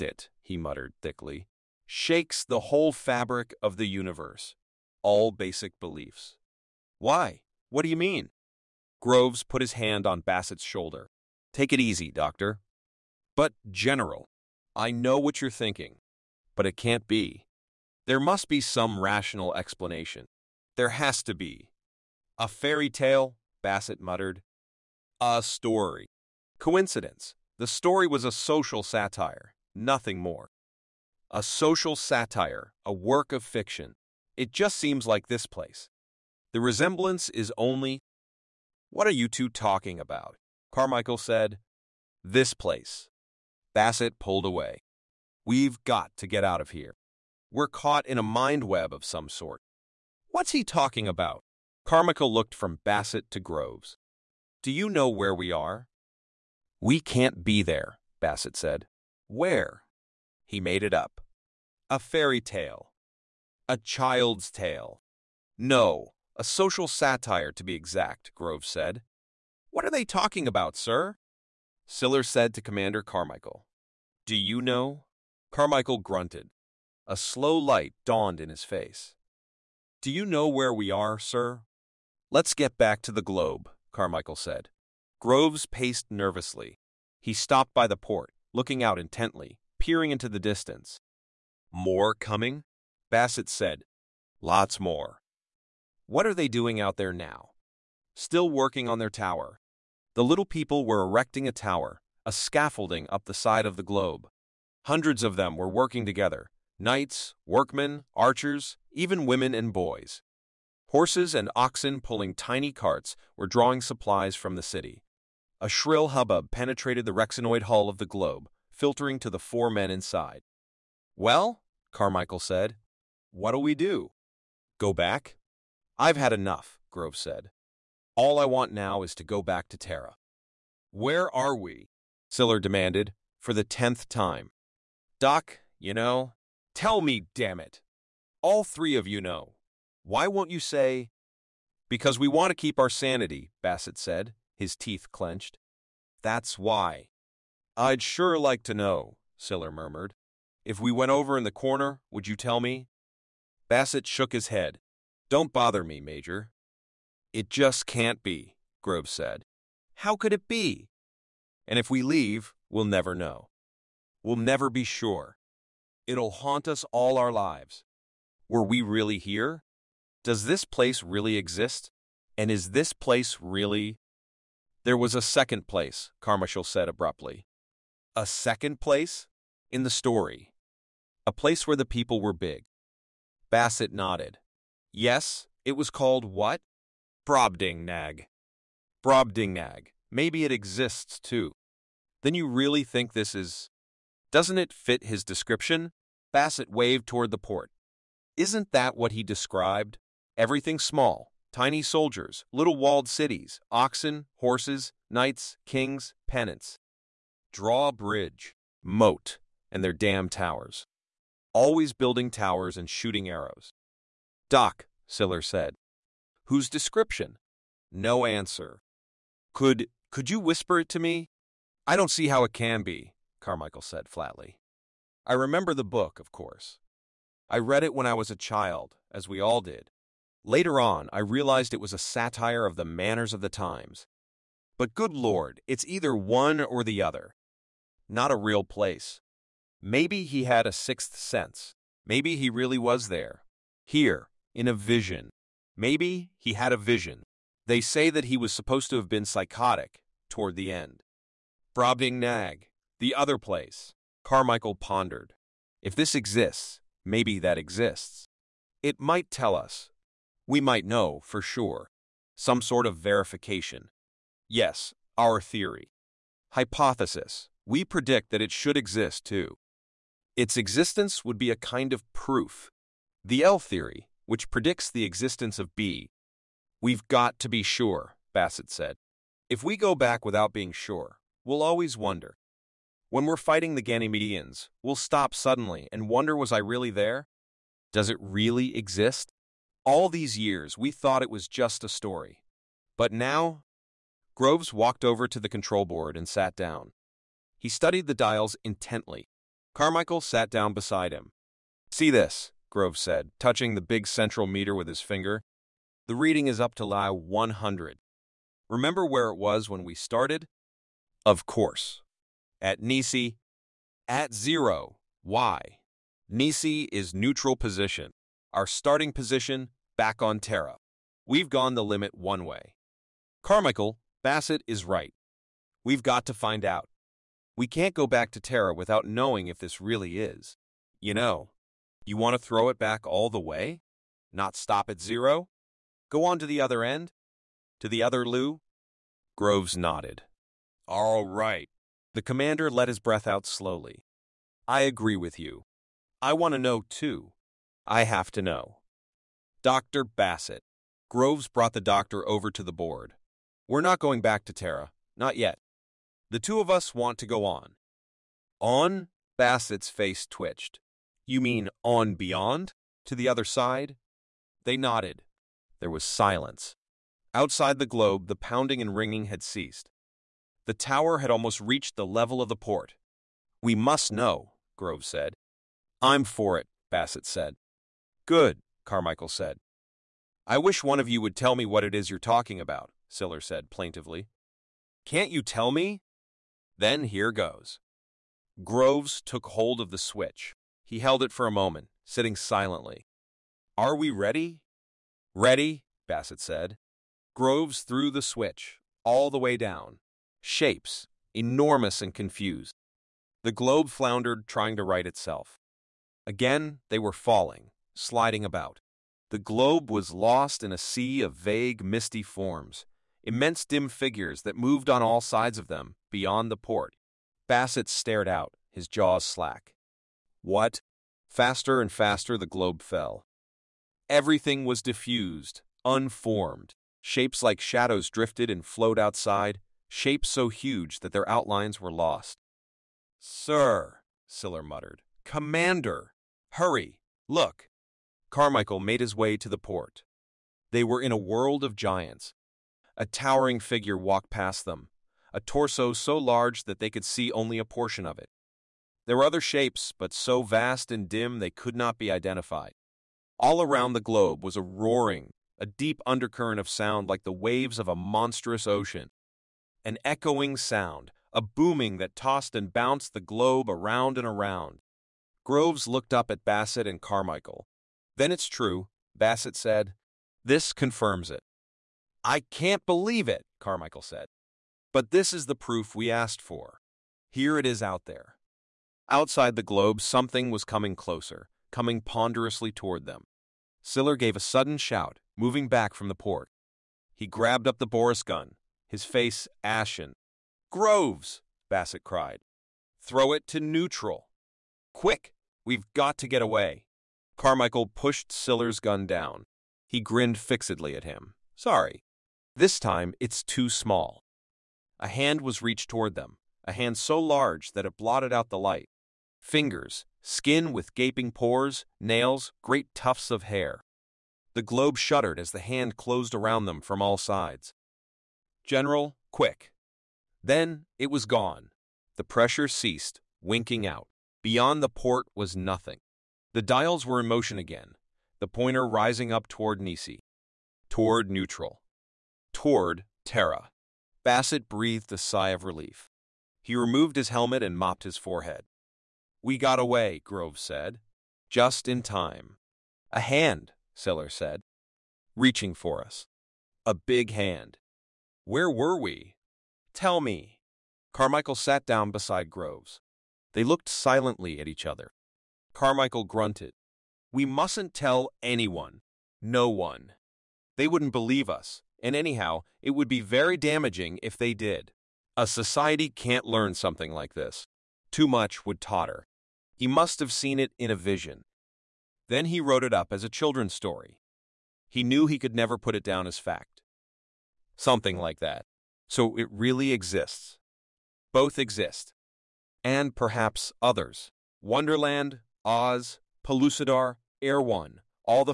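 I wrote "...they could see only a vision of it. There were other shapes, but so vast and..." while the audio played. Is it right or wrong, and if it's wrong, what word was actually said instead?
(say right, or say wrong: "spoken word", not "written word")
wrong: "portion", not "vision".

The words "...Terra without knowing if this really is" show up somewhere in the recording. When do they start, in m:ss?
5:28.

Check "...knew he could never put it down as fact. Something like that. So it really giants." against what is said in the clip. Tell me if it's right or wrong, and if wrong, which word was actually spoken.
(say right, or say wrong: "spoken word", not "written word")
wrong: "exists", not "giants".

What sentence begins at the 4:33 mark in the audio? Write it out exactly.
The L theory, which predicts the existence of B.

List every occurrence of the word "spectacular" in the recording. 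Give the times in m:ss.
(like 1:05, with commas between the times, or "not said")
not said.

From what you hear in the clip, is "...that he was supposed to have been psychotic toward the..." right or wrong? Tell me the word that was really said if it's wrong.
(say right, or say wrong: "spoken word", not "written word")
right.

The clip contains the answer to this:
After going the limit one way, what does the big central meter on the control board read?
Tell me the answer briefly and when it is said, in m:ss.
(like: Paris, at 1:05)
Lie 100, at 5:06.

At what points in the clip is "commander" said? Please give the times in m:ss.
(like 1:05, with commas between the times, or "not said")
1:12, 5:42, 7:15.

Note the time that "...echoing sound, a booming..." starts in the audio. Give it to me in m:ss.
7:40.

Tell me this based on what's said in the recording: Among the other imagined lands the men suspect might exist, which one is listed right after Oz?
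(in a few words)
Pellucidar.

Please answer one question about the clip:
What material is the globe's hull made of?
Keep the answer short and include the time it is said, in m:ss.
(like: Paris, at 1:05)
Rexinoid, at 1:57.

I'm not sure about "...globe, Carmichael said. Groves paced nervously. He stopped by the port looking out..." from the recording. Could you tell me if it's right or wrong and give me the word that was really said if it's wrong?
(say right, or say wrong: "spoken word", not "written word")
right.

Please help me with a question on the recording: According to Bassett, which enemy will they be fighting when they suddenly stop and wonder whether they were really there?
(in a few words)
Ganymedians.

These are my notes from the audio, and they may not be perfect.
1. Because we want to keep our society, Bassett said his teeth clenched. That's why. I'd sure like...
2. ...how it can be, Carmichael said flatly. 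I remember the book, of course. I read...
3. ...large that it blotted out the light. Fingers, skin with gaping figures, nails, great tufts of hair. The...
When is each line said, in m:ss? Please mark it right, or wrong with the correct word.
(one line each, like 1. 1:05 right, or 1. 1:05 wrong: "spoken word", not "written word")
1. 2:21 wrong: "sanity", not "society"
2. 3:42 right
3. 8:27 wrong: "pores", not "figures".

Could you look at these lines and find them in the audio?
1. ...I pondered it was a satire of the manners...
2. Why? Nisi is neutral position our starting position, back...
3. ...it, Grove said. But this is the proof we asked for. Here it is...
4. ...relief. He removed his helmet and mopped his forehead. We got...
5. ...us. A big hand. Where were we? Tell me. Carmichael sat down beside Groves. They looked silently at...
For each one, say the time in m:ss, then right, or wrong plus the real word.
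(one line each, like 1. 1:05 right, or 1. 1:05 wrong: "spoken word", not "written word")
1. 3:51 wrong: "realized", not "pondered"
2. 5:15 right
3. 7:53 wrong: "Carmichael", not "Grove"
4. 8:55 right
5. 9:06 right.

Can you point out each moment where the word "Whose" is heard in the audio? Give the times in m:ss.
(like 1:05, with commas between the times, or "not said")
3:36.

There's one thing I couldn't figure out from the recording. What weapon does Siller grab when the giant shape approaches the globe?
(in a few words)
Boris gun.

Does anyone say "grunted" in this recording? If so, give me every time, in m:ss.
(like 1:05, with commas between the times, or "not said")
1:15, 9:16.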